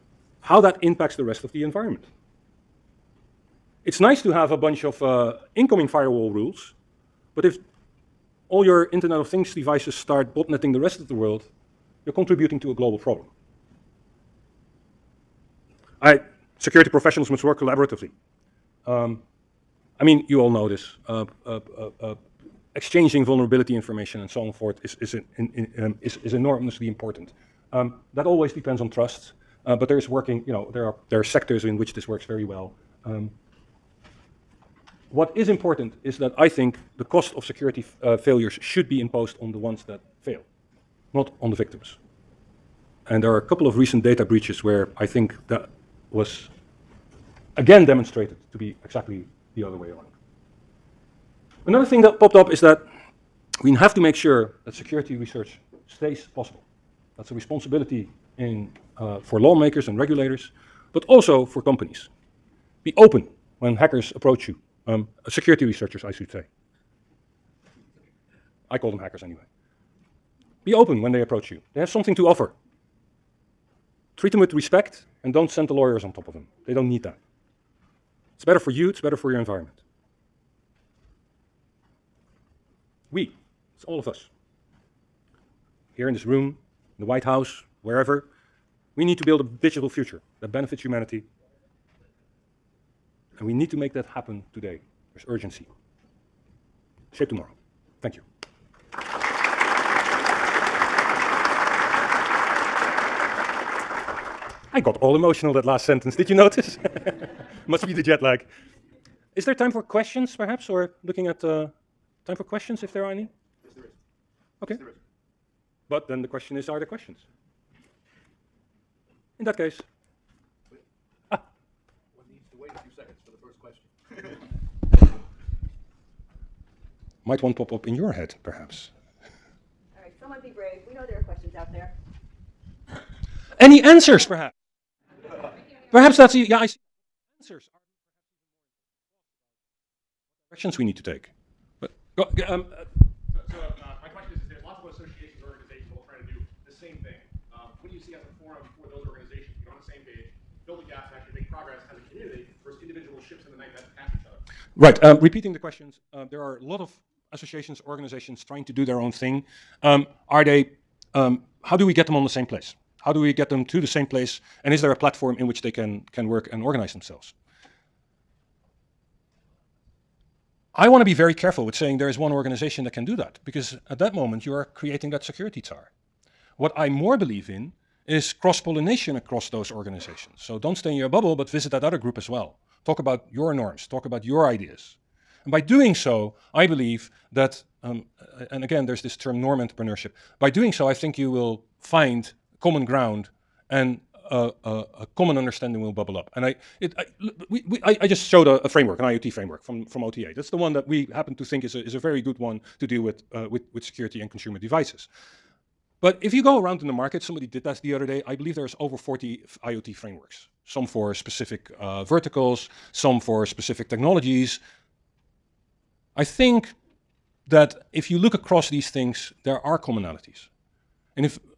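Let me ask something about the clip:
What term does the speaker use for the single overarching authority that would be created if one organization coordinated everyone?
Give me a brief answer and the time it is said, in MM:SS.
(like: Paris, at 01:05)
Security tsar, at 02:55.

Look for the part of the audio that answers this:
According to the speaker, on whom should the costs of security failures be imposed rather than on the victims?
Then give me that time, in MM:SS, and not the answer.
00:39.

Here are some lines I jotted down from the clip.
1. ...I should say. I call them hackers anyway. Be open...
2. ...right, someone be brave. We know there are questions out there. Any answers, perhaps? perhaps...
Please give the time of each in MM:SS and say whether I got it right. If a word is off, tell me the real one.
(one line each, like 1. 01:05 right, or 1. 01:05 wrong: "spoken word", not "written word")
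1. 01:06 right
2. 02:10 right.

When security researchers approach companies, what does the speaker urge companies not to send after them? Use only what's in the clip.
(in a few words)
The lawyers.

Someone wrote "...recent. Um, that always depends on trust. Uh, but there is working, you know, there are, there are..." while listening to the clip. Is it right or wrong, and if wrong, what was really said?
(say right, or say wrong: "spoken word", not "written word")
wrong: "important", not "recent".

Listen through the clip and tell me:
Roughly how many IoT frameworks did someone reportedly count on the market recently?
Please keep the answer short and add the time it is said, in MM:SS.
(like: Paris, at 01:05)
Over 40, at 03:28.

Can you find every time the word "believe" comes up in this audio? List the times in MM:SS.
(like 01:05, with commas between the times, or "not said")
02:57, 03:06, 03:28.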